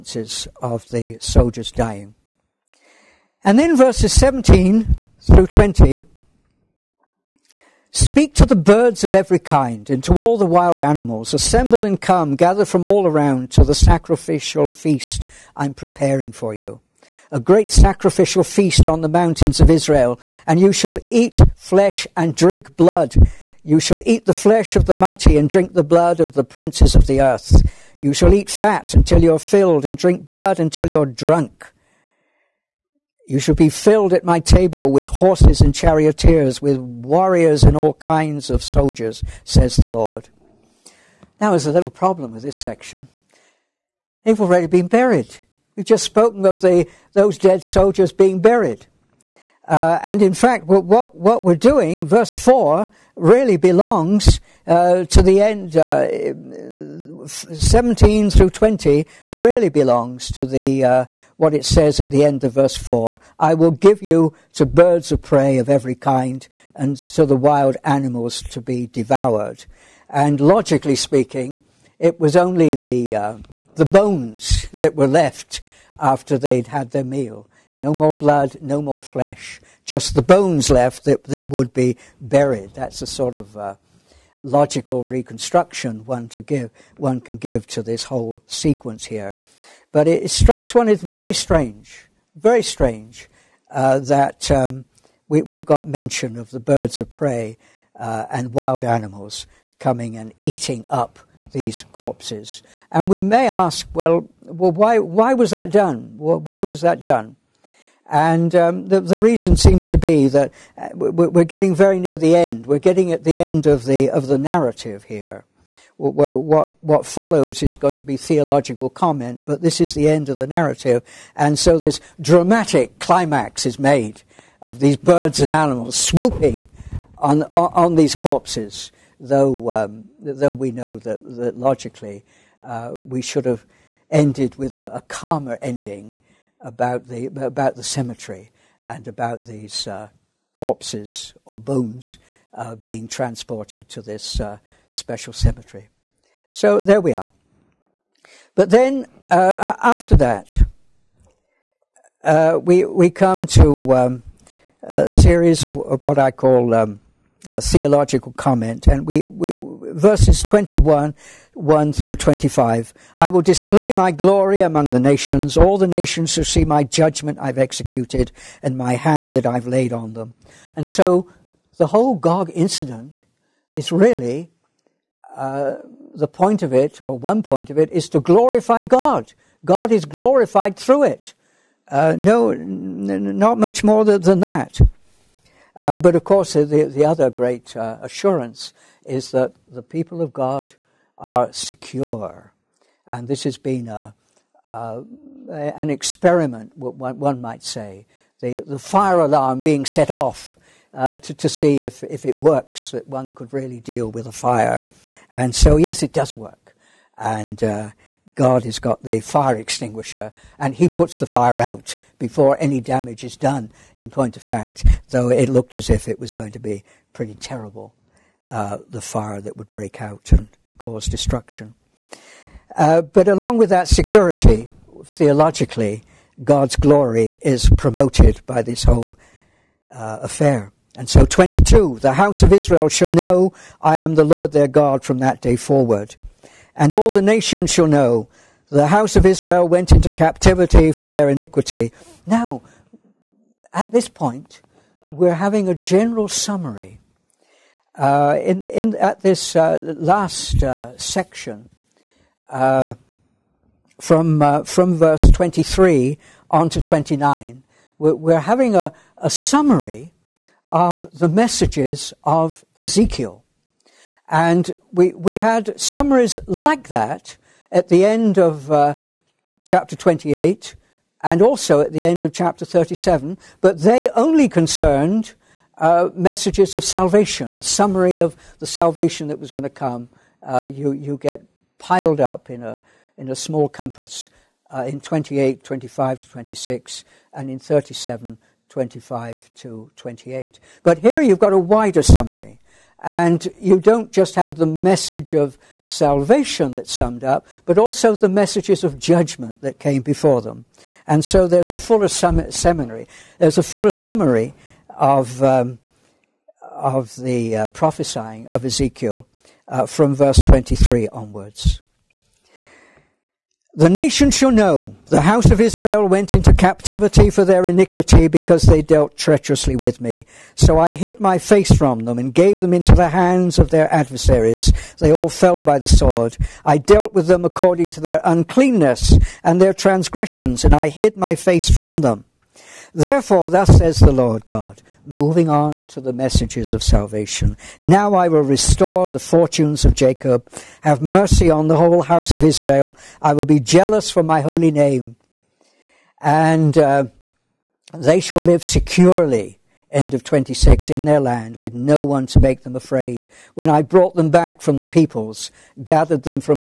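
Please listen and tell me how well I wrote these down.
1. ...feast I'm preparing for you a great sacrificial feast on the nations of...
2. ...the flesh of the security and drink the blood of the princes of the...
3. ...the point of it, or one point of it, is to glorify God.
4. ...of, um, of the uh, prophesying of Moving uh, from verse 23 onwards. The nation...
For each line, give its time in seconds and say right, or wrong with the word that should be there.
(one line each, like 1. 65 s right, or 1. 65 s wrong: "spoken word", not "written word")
1. 14 s wrong: "mountains", not "nations"
2. 24 s wrong: "mighty", not "security"
3. 176 s right
4. 304 s wrong: "Ezekiel", not "Moving".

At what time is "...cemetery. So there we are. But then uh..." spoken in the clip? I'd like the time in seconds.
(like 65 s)
145 s.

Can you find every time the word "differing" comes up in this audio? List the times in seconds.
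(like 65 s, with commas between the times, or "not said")
not said.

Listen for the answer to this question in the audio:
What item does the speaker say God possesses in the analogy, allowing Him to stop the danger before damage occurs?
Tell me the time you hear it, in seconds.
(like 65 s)
209 s.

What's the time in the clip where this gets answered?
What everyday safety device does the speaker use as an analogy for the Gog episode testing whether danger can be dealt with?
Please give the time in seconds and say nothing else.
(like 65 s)
198 s.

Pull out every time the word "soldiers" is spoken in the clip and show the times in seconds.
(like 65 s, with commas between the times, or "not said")
1 s, 38 s, 47 s.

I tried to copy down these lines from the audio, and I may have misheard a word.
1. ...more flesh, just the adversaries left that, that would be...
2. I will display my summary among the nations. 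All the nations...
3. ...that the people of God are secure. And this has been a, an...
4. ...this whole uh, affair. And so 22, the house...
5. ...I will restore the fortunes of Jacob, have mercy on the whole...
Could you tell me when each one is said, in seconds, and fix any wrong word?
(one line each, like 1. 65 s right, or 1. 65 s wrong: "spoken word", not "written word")
1. 78 s wrong: "bones", not "adversaries"
2. 163 s wrong: "glory", not "summary"
3. 189 s right
4. 228 s right
5. 338 s right.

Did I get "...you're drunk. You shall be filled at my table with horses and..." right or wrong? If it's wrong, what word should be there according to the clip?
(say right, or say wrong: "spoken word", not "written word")
right.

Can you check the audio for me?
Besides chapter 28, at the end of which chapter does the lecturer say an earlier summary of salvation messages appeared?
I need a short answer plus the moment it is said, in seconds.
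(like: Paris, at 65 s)
37, at 272 s.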